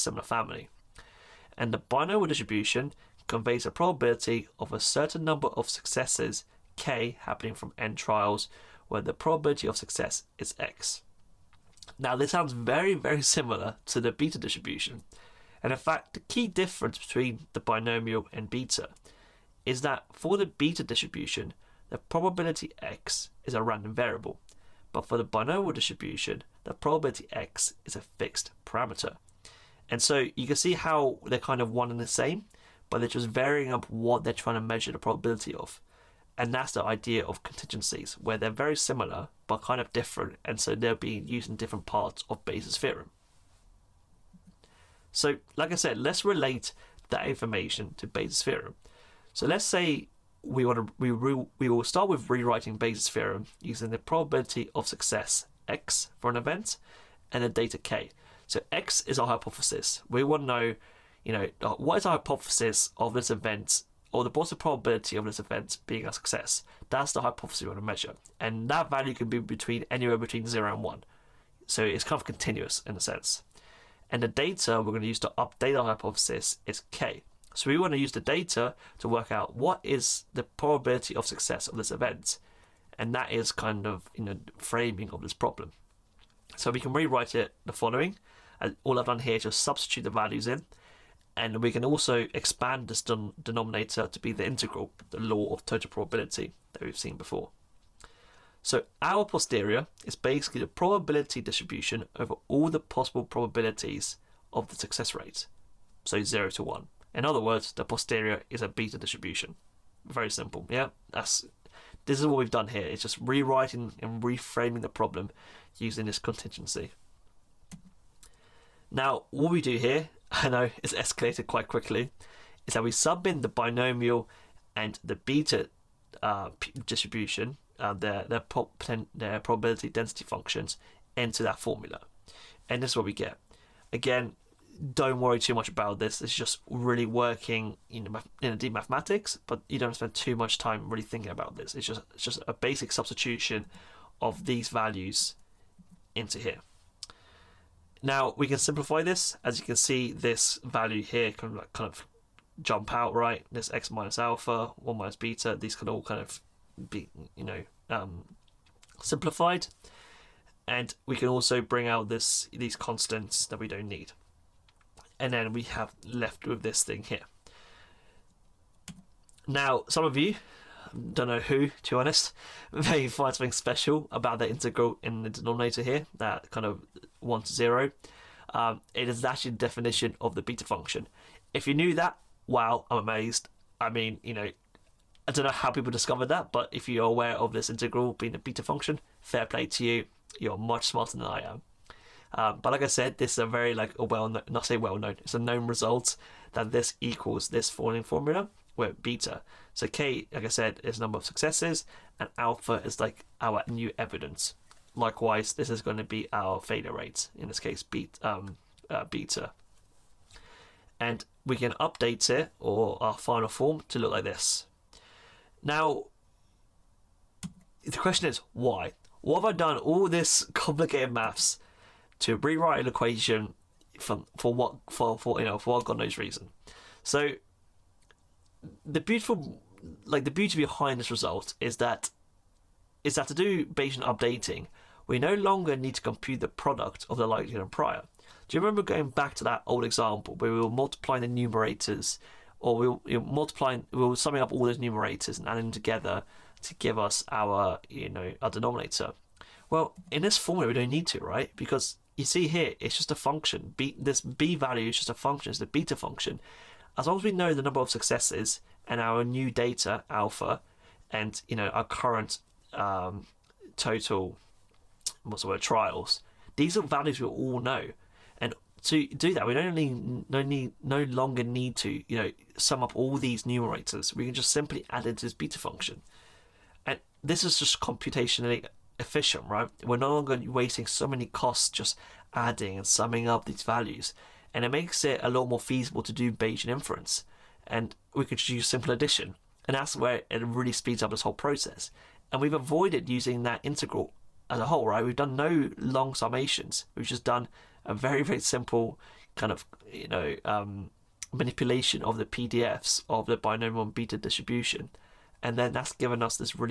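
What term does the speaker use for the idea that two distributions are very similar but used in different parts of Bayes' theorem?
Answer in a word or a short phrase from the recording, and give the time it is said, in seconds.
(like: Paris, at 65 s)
Conjugacies, at 37 s.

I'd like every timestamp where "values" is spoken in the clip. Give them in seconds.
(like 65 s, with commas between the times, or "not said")
68 s, 90 s, 144 s, 150 s, 254 s, 266 s, 283 s.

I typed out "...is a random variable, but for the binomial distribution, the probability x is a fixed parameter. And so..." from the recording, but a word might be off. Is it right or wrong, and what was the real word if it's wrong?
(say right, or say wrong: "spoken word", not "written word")
right.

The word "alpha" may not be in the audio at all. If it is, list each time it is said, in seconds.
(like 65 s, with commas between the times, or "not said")
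154 s, 202 s, 260 s.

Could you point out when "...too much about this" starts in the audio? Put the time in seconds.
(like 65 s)
135 s.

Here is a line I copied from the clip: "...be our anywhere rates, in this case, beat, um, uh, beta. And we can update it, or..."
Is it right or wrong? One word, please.
wrong.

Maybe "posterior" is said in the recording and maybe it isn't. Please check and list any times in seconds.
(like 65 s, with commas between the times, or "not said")
99 s, 107 s.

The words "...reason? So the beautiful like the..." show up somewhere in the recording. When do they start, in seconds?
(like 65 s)
226 s.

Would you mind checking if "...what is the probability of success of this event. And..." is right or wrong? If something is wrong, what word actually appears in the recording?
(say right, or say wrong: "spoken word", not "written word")
right.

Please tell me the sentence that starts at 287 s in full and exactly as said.
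And we could just use simple addition.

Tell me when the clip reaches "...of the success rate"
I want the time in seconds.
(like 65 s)
104 s.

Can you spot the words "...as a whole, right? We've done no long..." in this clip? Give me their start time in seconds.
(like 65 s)
294 s.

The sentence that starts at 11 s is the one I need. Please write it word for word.
Now, this sounds very, very similar to the beta distribution.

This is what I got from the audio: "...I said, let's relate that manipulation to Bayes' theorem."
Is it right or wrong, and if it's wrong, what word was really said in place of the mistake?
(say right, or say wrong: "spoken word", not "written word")
wrong: "information", not "manipulation".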